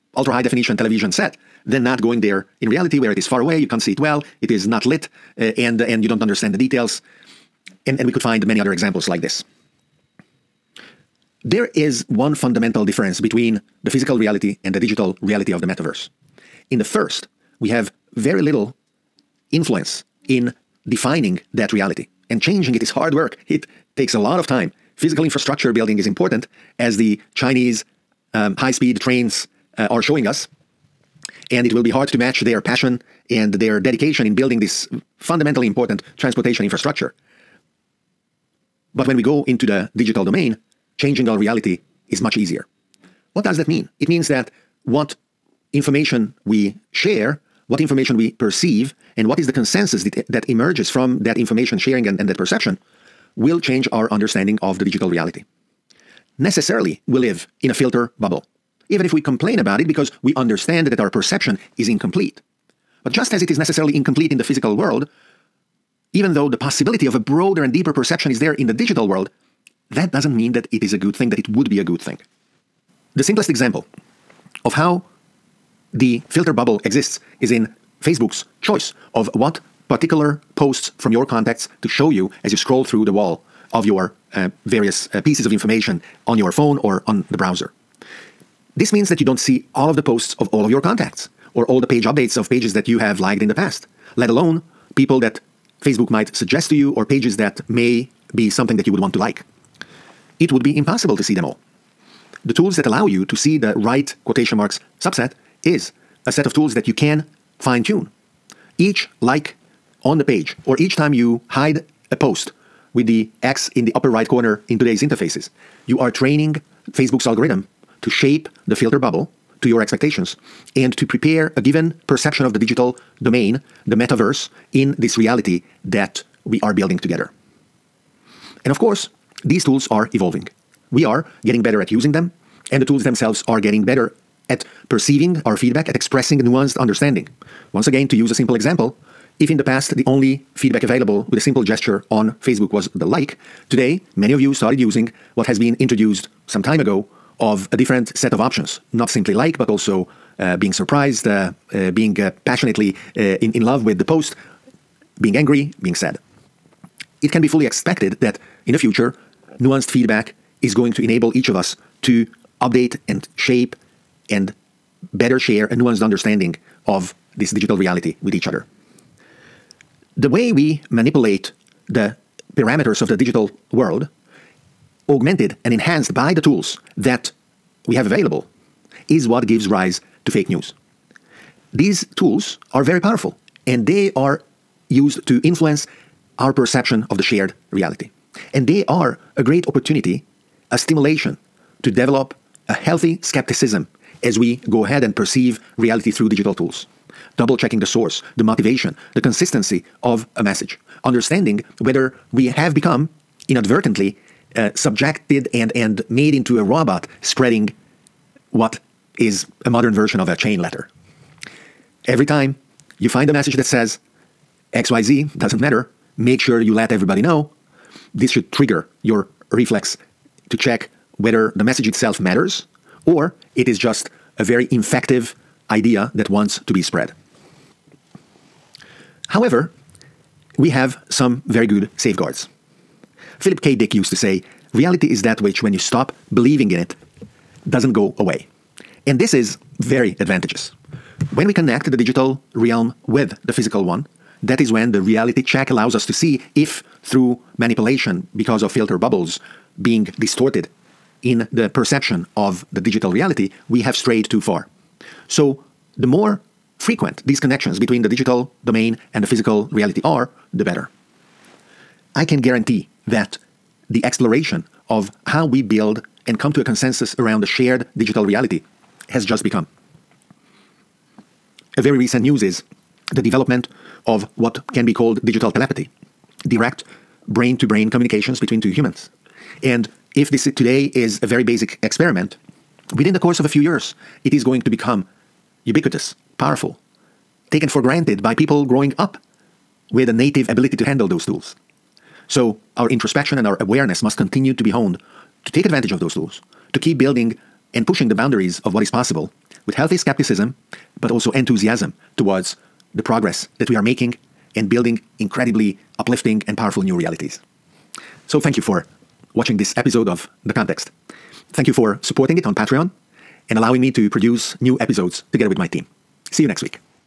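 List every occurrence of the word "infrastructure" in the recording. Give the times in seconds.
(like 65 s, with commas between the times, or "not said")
25 s, 36 s.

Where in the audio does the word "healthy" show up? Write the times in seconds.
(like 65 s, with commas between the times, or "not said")
192 s, 299 s.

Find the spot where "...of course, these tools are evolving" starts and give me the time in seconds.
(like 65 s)
128 s.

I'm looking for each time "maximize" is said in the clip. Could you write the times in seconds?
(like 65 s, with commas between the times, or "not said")
not said.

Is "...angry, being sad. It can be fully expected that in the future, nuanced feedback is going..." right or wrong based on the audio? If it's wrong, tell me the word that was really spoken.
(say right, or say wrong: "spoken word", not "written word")
right.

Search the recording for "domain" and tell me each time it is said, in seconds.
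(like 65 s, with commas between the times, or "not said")
40 s, 123 s, 258 s.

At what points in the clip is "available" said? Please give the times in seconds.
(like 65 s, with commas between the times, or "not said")
140 s, 178 s.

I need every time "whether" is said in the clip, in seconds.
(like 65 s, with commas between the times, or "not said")
201 s, 221 s.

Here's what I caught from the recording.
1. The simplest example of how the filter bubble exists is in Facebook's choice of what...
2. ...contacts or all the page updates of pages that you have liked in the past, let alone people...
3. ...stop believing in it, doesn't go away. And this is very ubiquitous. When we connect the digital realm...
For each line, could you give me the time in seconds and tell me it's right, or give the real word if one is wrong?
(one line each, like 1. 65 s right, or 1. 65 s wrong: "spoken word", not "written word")
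1. 73 s right
2. 90 s right
3. 235 s wrong: "advantageous", not "ubiquitous".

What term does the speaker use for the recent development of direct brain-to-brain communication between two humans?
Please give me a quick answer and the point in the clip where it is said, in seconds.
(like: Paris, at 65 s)
digital telepathy, at 275 s.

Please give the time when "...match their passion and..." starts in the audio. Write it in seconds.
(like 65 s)
32 s.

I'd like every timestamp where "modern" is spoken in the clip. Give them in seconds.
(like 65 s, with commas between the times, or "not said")
209 s.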